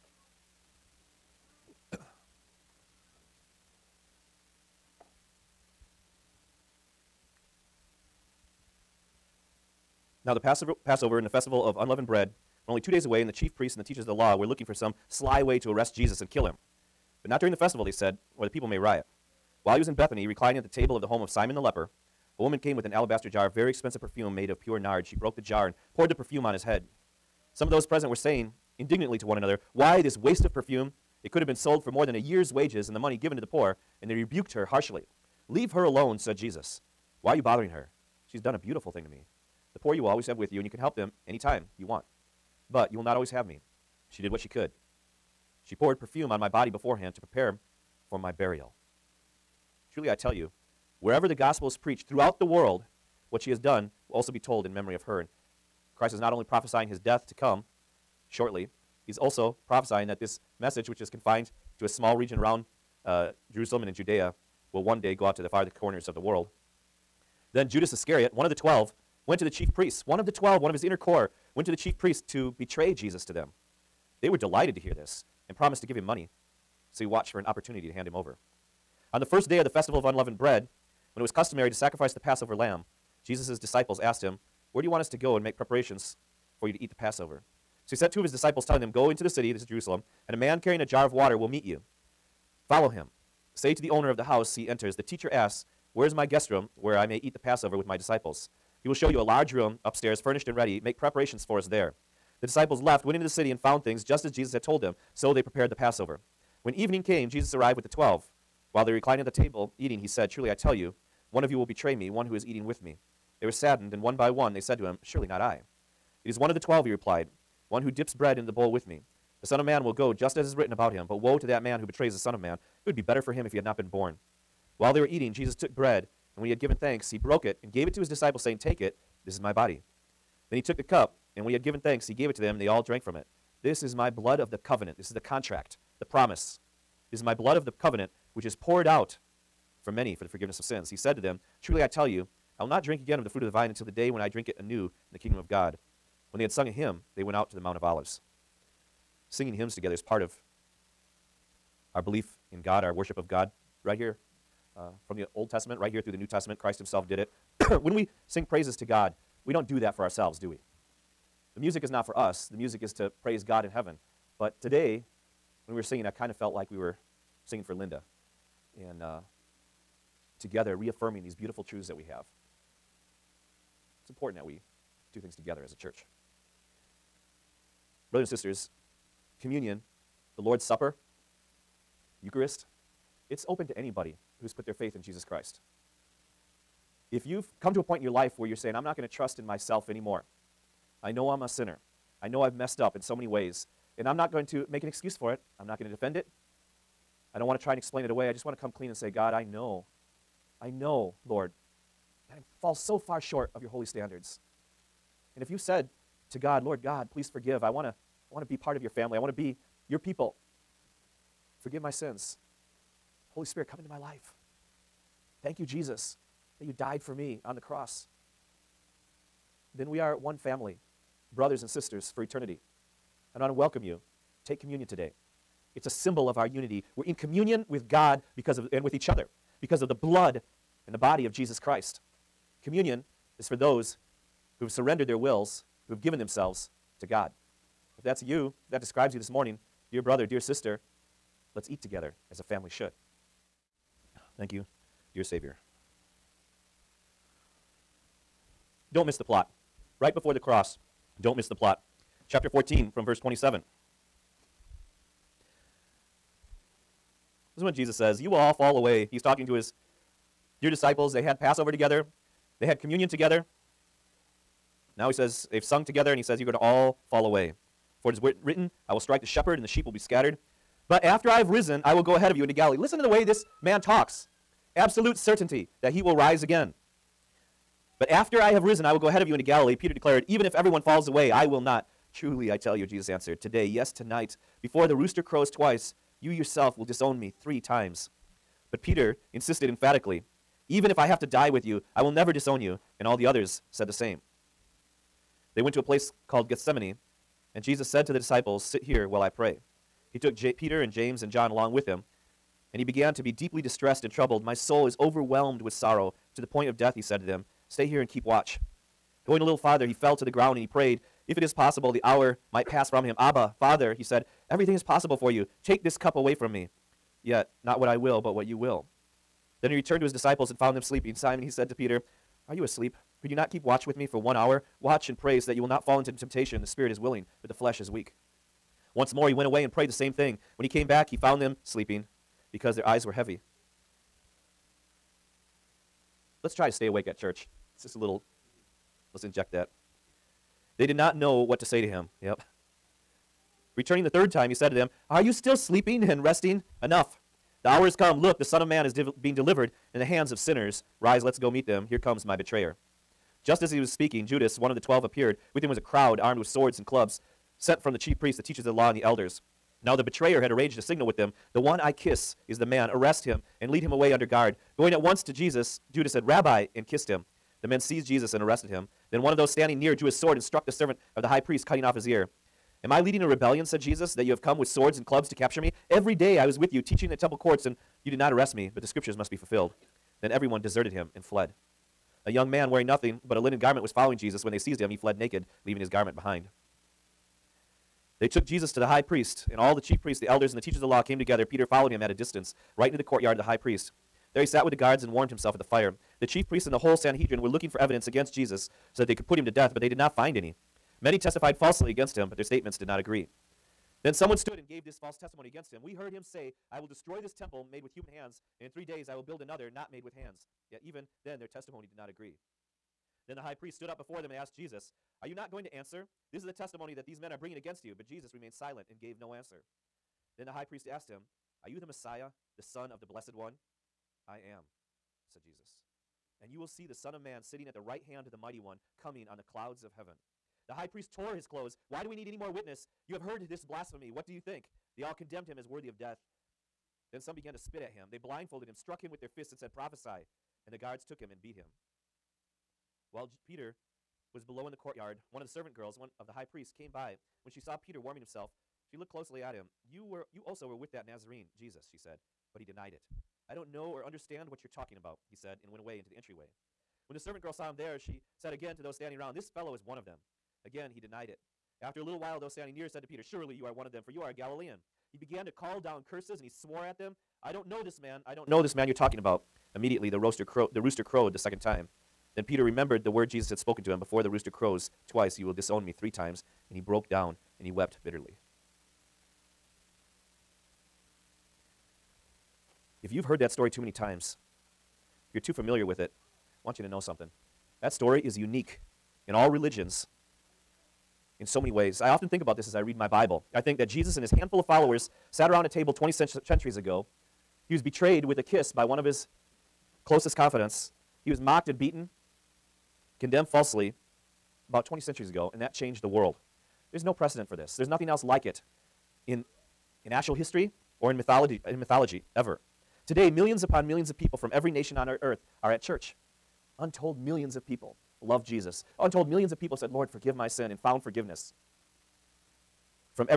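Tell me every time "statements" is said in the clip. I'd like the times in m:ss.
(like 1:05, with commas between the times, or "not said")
6:42.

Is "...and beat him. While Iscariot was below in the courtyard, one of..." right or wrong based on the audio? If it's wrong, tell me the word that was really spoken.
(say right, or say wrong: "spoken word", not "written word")
wrong: "Peter", not "Iscariot".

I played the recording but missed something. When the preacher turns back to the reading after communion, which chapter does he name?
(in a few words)
Chapter 14.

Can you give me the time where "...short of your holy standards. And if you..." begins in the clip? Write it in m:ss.
3:23.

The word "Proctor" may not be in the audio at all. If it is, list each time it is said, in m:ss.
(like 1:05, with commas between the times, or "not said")
not said.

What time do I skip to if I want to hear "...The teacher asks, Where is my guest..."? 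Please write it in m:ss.
1:34.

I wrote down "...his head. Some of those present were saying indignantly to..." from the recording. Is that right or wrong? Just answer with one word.
right.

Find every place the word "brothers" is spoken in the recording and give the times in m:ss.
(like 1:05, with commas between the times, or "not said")
2:58, 3:41, 3:59.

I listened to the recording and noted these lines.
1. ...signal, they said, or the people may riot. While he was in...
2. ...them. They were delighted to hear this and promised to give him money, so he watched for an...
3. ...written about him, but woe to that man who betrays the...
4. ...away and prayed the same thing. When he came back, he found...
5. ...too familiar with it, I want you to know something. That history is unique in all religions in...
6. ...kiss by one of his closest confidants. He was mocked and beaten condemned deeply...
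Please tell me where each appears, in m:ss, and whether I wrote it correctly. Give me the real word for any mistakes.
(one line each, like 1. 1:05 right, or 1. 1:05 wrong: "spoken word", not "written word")
1. 0:17 wrong: "festival", not "signal"
2. 1:13 right
3. 2:00 right
4. 5:29 right
5. 8:05 wrong: "story", not "history"
6. 8:18 wrong: "falsely", not "deeply".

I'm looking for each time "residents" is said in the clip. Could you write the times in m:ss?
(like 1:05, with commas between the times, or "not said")
not said.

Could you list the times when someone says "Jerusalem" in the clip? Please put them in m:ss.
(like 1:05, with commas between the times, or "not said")
1:03, 1:29.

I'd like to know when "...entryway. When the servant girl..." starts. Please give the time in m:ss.
7:36.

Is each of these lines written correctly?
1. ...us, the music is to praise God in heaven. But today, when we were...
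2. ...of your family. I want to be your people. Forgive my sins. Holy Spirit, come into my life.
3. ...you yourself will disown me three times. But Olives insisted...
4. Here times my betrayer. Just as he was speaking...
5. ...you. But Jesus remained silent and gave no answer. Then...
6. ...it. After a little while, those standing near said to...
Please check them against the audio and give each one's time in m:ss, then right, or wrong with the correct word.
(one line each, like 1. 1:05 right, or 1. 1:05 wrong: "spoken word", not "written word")
1. 2:42 right
2. 3:28 right
3. 4:46 wrong: "Peter", not "Olives"
4. 5:51 wrong: "comes", not "times"
5. 6:57 right
6. 7:41 right.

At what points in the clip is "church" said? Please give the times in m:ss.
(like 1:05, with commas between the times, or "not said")
2:55, 5:37, 8:35.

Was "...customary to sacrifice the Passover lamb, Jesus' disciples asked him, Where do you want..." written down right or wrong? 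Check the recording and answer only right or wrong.
right.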